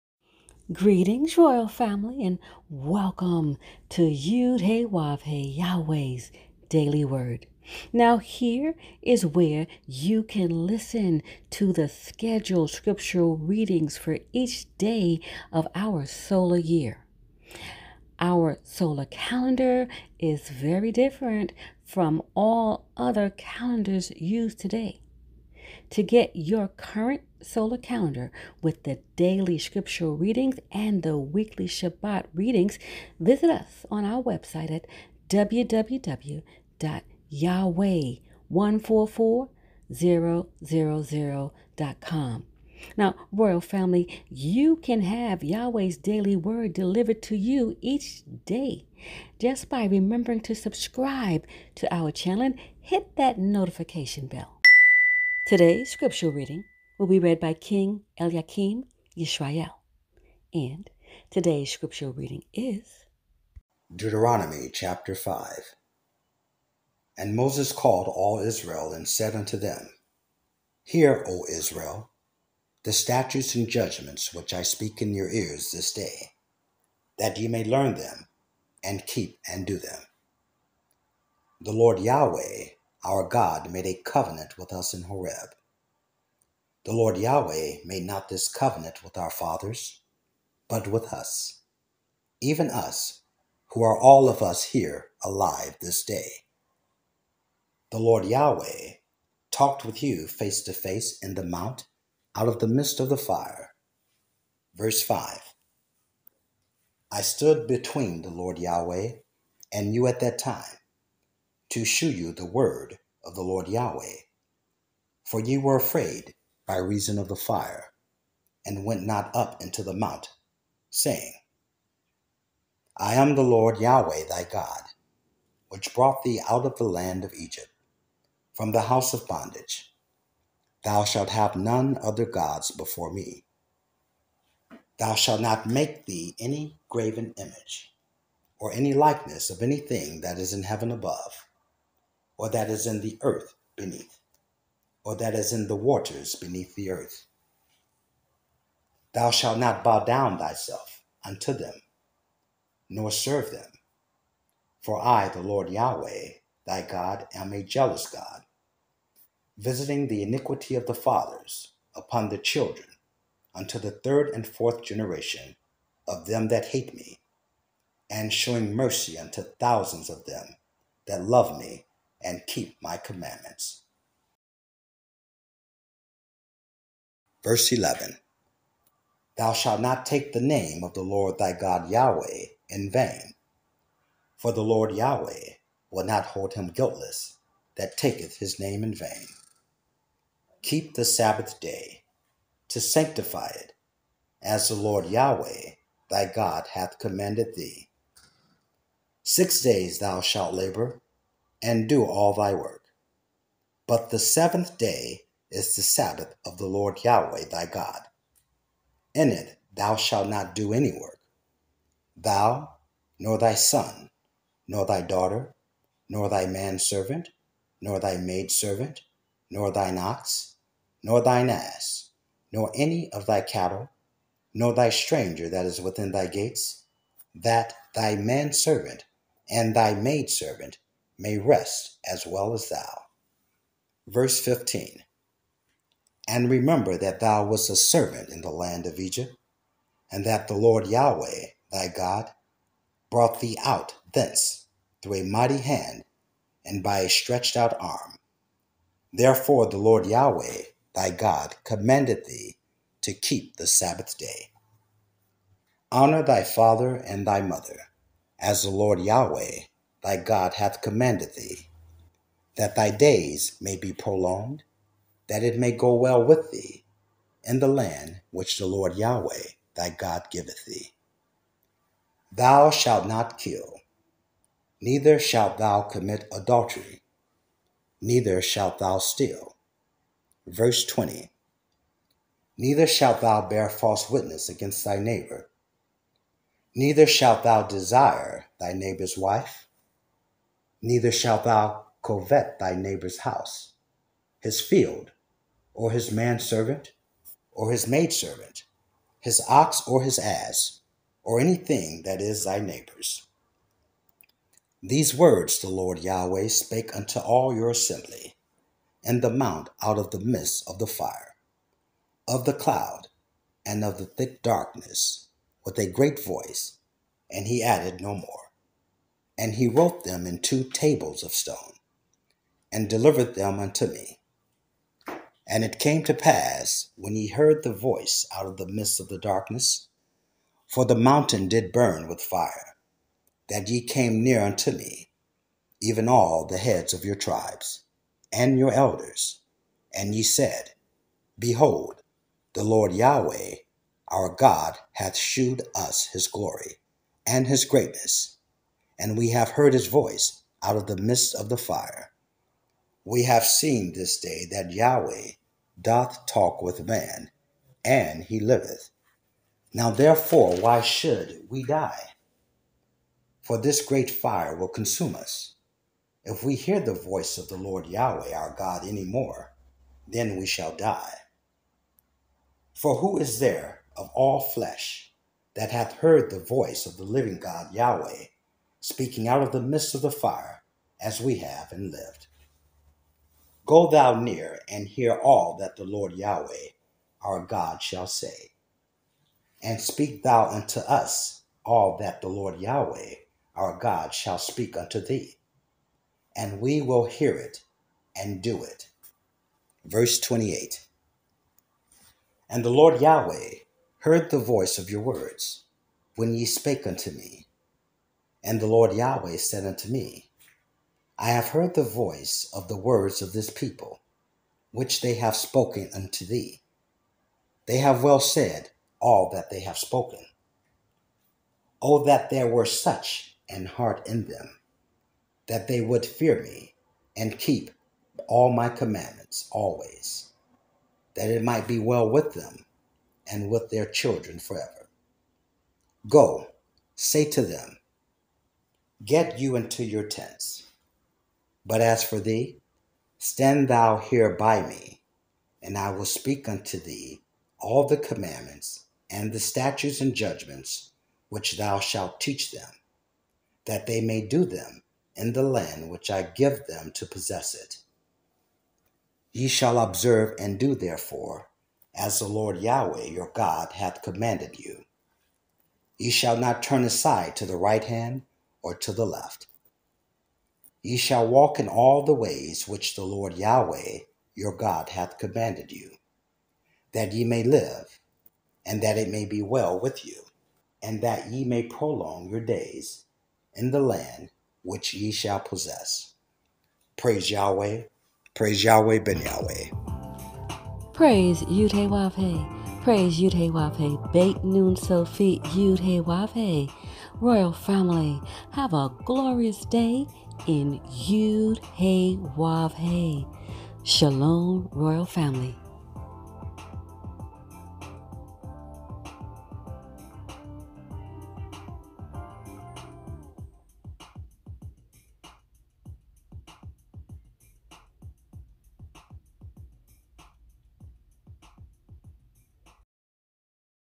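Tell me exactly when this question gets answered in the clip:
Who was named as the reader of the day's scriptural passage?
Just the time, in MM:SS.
00:57.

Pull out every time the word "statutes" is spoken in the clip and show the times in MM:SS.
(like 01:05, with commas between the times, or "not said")
01:12, 07:29.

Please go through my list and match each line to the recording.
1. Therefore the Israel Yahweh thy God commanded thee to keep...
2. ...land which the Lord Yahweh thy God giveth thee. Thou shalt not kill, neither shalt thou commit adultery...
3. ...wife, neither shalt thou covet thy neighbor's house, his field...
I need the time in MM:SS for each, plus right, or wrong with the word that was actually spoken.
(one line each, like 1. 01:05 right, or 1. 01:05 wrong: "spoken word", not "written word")
1. 04:09 wrong: "Lord", not "Israel"
2. 04:27 right
3. 04:49 right.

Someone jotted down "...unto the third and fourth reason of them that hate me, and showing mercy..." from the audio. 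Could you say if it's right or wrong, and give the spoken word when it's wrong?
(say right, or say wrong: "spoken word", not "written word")
wrong: "generation", not "reason".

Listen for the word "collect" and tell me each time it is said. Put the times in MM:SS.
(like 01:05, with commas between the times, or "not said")
not said.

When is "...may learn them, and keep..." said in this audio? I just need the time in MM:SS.
01:17.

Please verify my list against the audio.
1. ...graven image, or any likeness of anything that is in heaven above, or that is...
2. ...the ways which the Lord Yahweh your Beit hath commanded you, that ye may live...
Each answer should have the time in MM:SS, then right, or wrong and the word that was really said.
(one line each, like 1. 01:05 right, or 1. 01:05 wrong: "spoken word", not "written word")
1. 02:16 right
2. 07:52 wrong: "God", not "Beit".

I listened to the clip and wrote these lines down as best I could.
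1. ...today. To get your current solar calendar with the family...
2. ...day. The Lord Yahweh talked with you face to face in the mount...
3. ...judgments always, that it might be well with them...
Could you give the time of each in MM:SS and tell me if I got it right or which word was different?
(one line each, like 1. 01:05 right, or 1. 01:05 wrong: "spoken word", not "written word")
1. 00:24 wrong: "daily", not "family"
2. 01:36 right
3. 07:08 wrong: "commandments", not "judgments".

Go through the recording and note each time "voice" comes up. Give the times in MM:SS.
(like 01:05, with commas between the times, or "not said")
05:16, 05:27, 05:49, 06:06, 06:16, 06:44, 06:51.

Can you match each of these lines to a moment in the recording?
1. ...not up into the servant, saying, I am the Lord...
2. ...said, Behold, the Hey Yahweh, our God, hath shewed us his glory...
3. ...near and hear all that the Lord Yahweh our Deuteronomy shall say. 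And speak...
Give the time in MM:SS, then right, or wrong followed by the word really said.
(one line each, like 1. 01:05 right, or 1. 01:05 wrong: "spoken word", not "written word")
1. 01:59 wrong: "mount", not "servant"
2. 05:40 wrong: "Lord", not "Hey"
3. 06:24 wrong: "God", not "Deuteronomy".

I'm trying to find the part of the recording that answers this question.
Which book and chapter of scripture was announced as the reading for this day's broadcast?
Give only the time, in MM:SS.
01:03.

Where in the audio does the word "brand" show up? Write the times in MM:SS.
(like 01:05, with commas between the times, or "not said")
not said.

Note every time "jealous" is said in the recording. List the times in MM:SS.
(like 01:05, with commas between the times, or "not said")
02:37.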